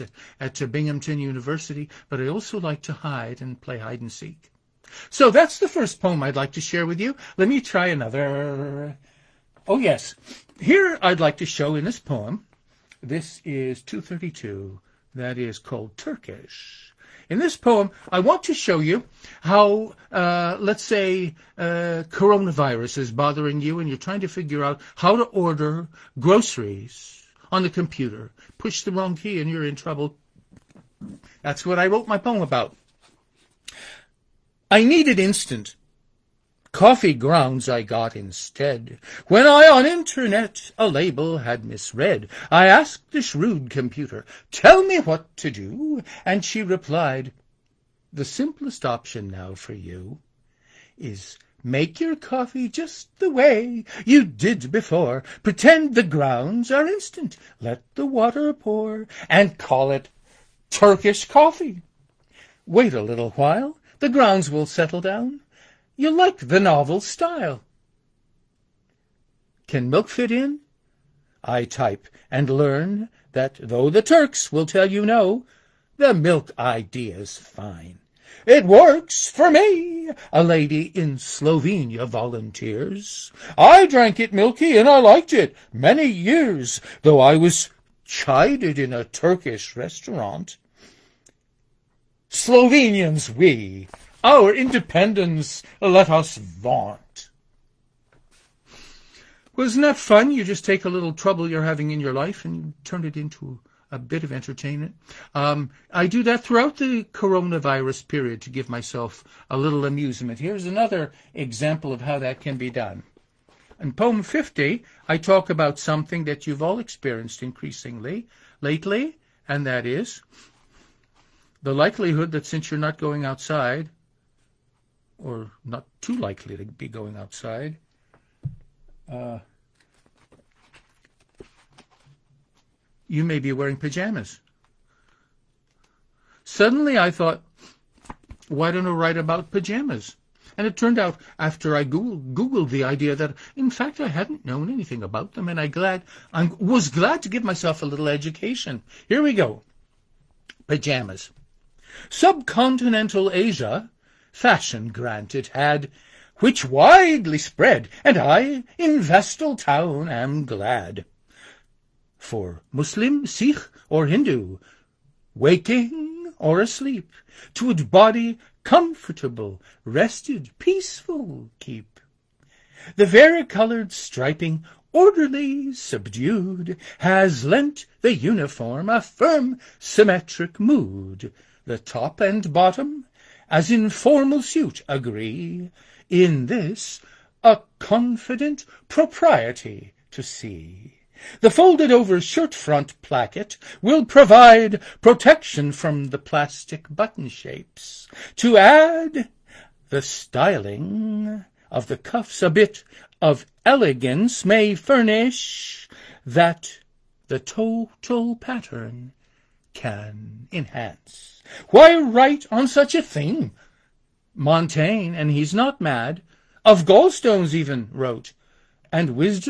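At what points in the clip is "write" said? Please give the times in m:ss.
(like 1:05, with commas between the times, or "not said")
2:18, 3:31.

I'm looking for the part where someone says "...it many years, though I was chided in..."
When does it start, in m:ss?
1:25.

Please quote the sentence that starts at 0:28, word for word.
Push the wrong key and you're in trouble.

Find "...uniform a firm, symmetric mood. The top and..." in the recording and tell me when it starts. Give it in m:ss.
2:58.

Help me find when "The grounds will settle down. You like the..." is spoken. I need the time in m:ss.
1:03.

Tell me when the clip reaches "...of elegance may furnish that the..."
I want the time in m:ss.
3:23.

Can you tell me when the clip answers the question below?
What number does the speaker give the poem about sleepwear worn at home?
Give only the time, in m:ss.
1:54.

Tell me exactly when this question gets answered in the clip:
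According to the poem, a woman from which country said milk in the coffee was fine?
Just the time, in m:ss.
1:21.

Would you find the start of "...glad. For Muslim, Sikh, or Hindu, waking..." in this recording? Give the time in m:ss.
2:40.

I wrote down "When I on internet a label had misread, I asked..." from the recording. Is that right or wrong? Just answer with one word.
right.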